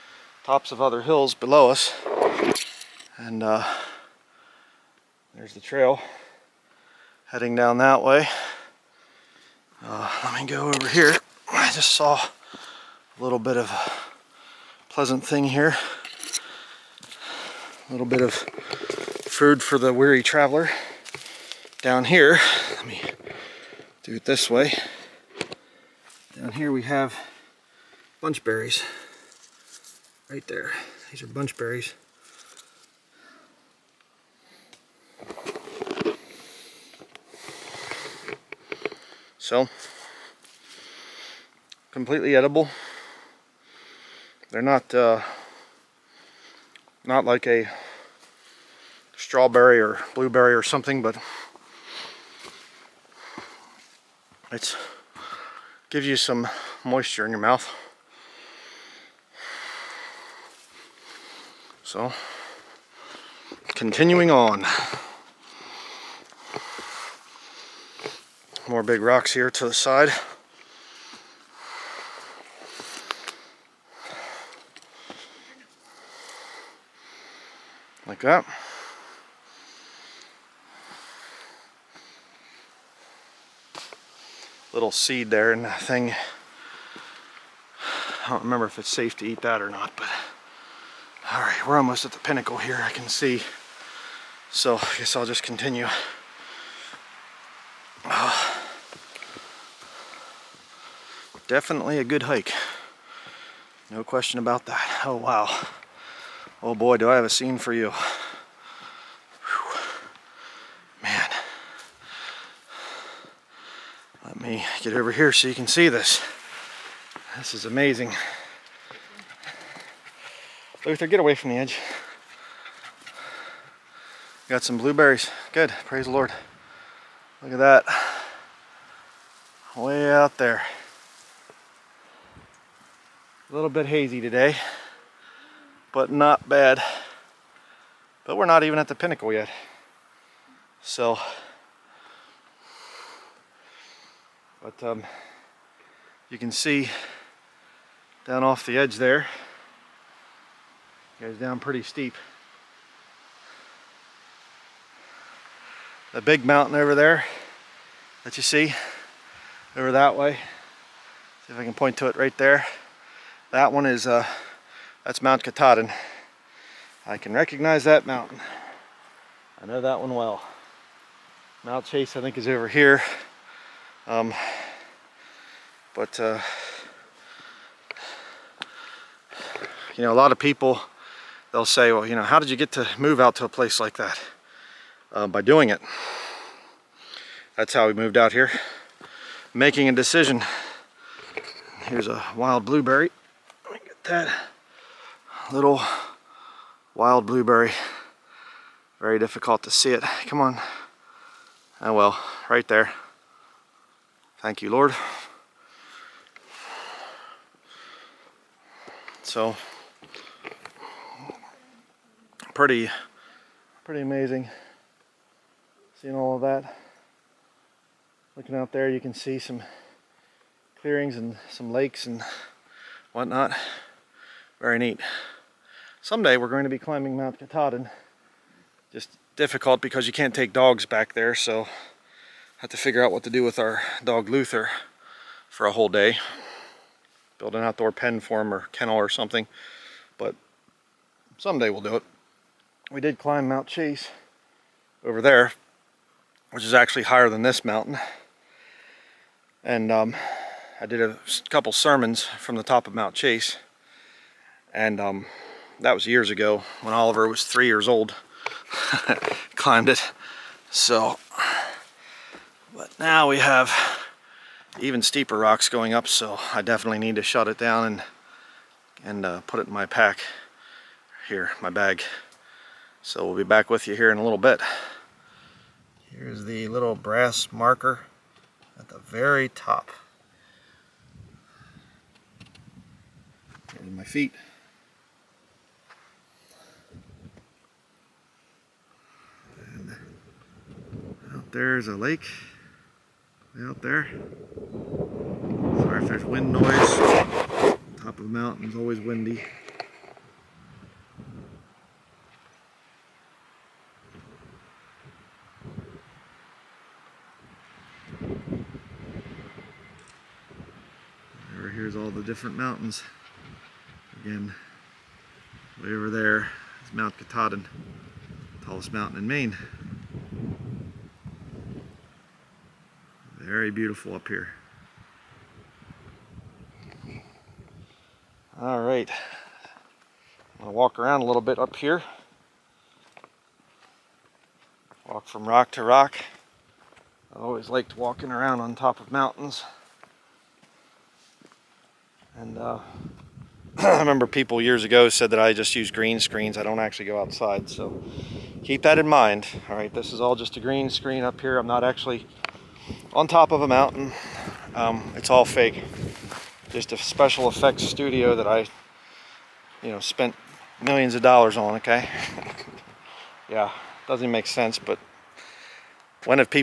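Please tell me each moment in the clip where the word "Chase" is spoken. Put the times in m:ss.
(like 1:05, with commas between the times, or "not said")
2:51, 4:03, 4:13.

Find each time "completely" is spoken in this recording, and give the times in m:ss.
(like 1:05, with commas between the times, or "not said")
0:41.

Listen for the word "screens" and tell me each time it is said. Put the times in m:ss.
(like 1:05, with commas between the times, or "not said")
5:46, 5:50.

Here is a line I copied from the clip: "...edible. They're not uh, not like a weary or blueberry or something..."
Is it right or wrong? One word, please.
wrong.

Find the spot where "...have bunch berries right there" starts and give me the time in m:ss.
0:26.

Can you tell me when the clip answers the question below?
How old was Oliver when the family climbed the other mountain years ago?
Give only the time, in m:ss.
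4:17.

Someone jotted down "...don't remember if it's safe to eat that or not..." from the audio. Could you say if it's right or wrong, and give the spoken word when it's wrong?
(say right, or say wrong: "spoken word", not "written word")
right.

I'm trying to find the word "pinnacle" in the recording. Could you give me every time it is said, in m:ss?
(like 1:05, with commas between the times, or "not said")
1:32, 2:18.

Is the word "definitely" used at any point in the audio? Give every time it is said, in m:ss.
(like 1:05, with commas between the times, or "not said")
1:41, 4:26.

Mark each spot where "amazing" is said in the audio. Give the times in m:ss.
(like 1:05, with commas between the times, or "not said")
1:57, 3:34.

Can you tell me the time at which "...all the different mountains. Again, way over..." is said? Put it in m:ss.
5:11.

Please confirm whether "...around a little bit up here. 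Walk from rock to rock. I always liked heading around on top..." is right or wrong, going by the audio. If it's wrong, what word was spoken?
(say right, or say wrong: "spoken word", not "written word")
wrong: "walking", not "heading".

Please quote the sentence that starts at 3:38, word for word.
Looking out there, you can see some clearings and some lakes and whatnot.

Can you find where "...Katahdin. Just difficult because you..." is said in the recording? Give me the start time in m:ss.
3:47.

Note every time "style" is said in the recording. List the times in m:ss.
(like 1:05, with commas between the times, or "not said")
not said.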